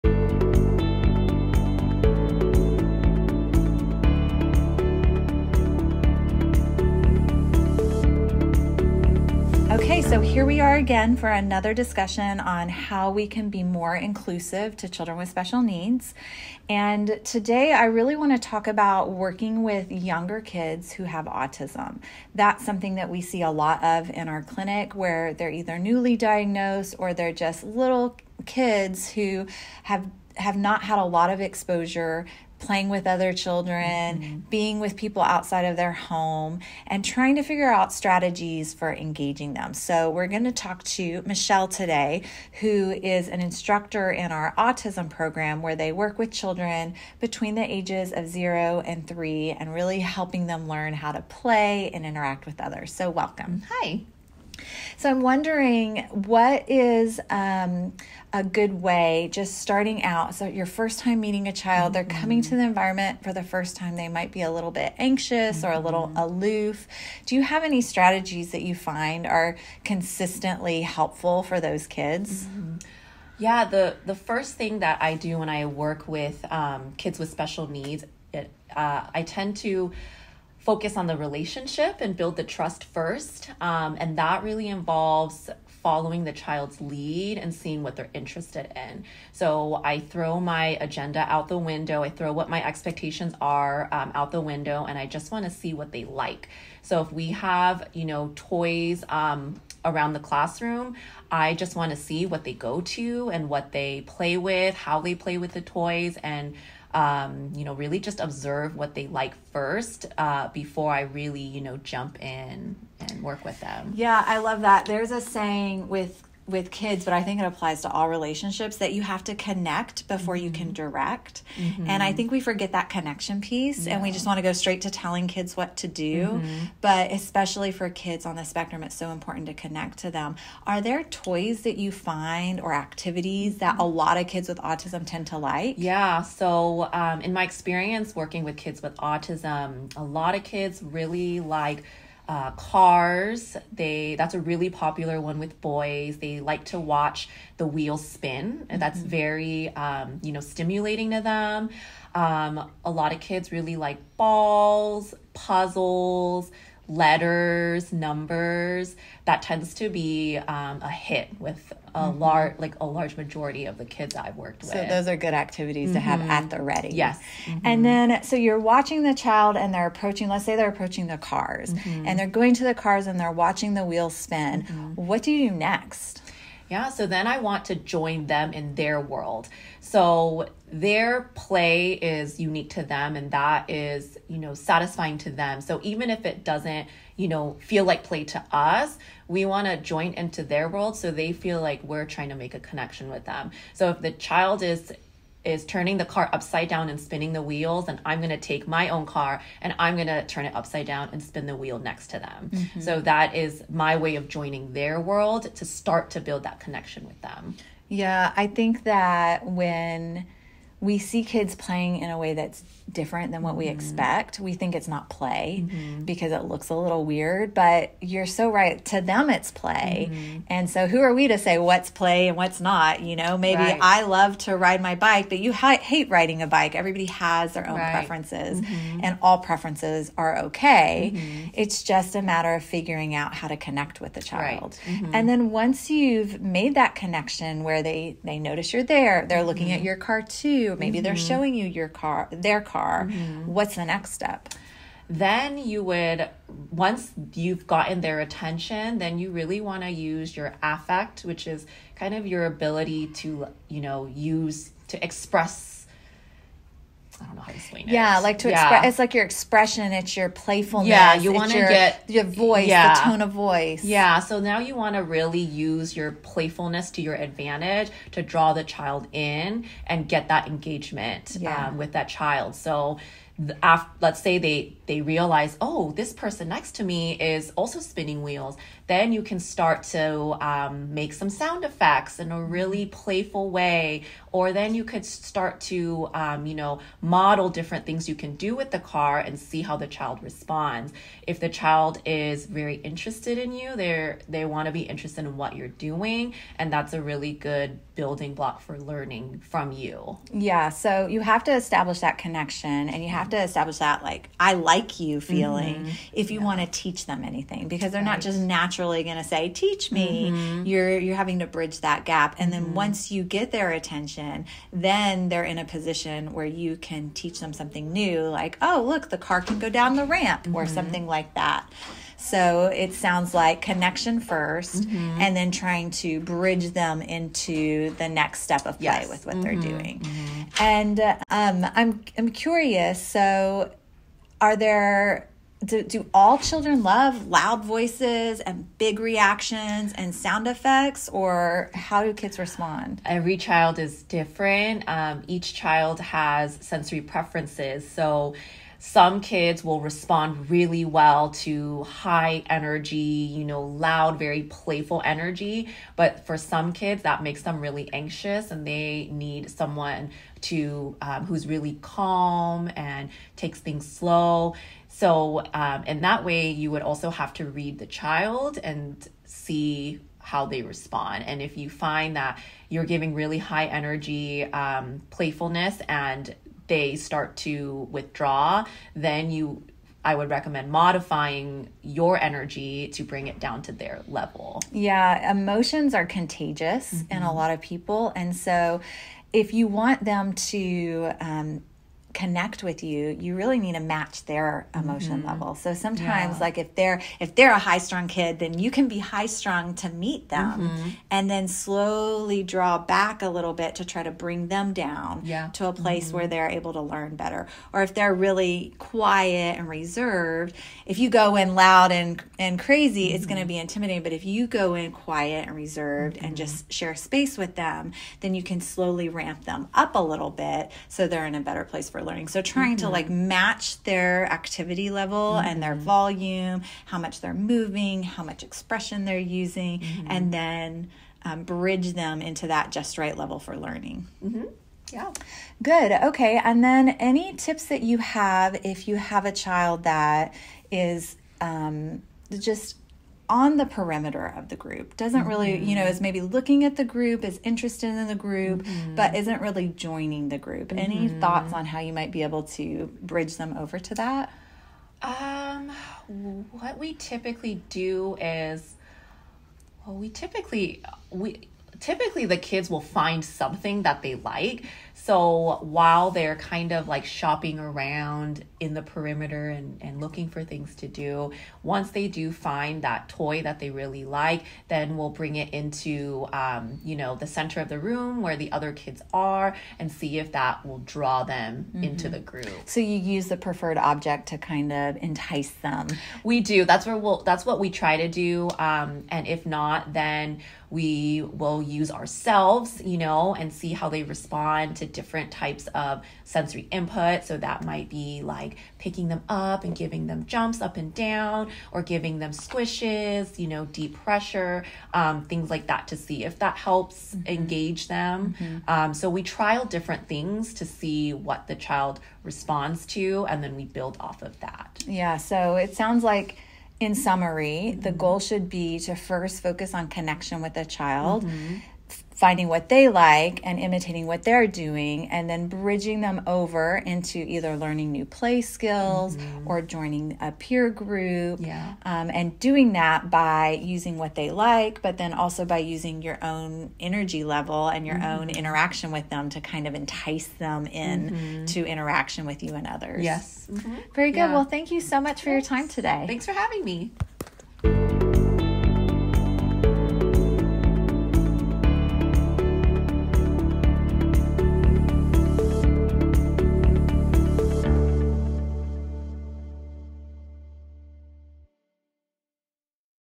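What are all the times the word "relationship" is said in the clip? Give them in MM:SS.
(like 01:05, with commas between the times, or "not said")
01:21, 01:58.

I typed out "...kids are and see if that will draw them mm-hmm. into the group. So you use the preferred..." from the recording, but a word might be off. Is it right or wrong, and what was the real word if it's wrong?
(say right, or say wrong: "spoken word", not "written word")
right.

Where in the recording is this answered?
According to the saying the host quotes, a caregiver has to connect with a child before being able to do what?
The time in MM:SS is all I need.
02:00.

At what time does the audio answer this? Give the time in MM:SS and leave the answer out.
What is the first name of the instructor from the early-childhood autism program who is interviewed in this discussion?
00:41.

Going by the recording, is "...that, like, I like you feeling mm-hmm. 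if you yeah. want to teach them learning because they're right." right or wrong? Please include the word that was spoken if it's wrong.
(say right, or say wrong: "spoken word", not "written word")
wrong: "anything", not "learning".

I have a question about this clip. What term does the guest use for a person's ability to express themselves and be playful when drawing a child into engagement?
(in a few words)
Affect.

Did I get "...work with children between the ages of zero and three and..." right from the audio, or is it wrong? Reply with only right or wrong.
right.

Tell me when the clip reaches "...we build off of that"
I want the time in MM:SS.
08:33.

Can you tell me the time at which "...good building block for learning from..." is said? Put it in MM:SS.
04:57.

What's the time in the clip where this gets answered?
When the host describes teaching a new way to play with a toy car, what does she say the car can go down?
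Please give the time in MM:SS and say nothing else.
05:19.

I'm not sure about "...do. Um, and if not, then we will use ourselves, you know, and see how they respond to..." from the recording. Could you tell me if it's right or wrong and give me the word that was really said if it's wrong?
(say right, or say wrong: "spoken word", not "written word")
right.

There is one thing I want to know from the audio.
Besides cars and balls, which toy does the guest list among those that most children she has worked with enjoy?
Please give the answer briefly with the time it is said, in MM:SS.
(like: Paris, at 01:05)
Puzzles, at 02:35.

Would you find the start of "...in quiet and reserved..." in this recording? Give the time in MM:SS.
06:54.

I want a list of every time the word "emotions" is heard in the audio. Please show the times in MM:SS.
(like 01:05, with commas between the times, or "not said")
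06:25, 06:34.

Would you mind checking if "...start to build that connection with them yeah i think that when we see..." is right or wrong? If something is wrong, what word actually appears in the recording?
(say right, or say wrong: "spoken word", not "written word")
right.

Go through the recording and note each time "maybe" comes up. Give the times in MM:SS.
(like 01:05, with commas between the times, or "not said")
03:43, 04:00, 07:26.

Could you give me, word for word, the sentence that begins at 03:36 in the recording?
because it looks a little weird, but you're so right.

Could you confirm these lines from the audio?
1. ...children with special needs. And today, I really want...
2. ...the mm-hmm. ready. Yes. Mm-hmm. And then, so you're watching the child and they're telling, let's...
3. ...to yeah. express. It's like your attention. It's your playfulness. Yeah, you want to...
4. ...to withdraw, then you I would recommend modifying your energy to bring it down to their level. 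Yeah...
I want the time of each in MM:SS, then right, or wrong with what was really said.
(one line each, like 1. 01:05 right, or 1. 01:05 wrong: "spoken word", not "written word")
1. 00:14 right
2. 02:46 wrong: "approaching", not "telling"
3. 04:18 wrong: "expression", not "attention"
4. 06:17 right.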